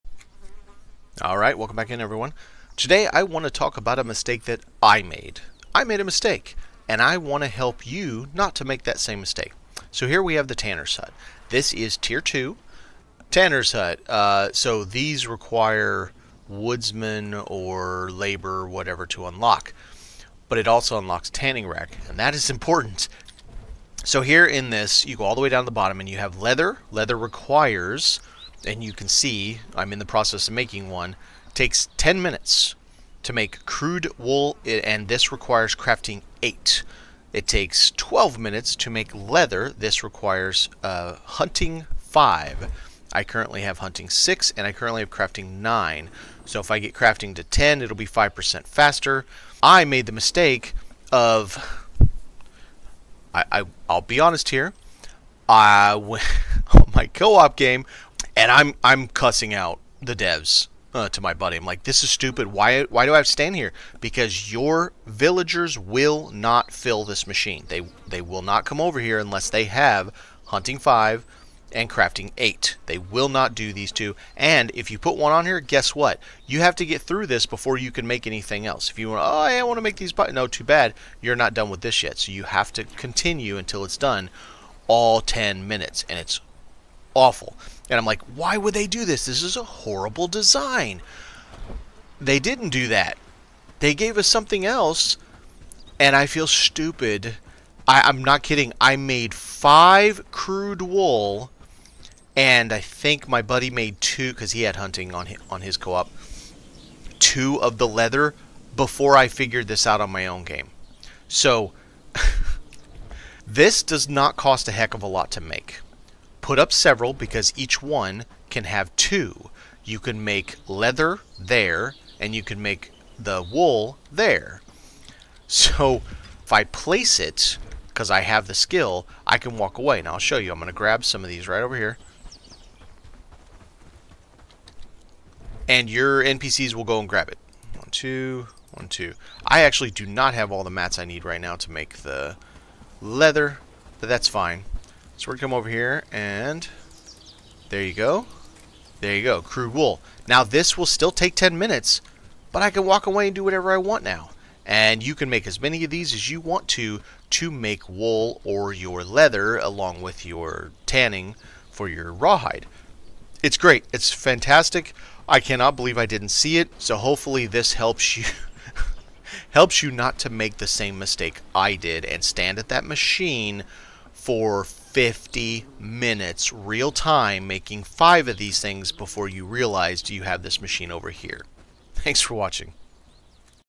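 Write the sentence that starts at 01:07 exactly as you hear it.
They they will not come over here unless they have hunting five and crafting eight.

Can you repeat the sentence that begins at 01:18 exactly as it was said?
If you want, oh, I want to make these, but no, too bad.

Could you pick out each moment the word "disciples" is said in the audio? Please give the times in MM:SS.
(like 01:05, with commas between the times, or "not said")
not said.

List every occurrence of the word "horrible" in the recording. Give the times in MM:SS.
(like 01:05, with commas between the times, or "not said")
01:29.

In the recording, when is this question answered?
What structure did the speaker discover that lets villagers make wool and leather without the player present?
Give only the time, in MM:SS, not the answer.
00:21.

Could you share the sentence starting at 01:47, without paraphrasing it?
Two of the leather before I figured this out on my own game.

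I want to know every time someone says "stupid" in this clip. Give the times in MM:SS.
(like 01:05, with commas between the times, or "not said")
01:02, 01:36.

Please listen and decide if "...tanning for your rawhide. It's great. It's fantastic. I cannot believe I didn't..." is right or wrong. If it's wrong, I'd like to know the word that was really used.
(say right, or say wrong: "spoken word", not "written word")
right.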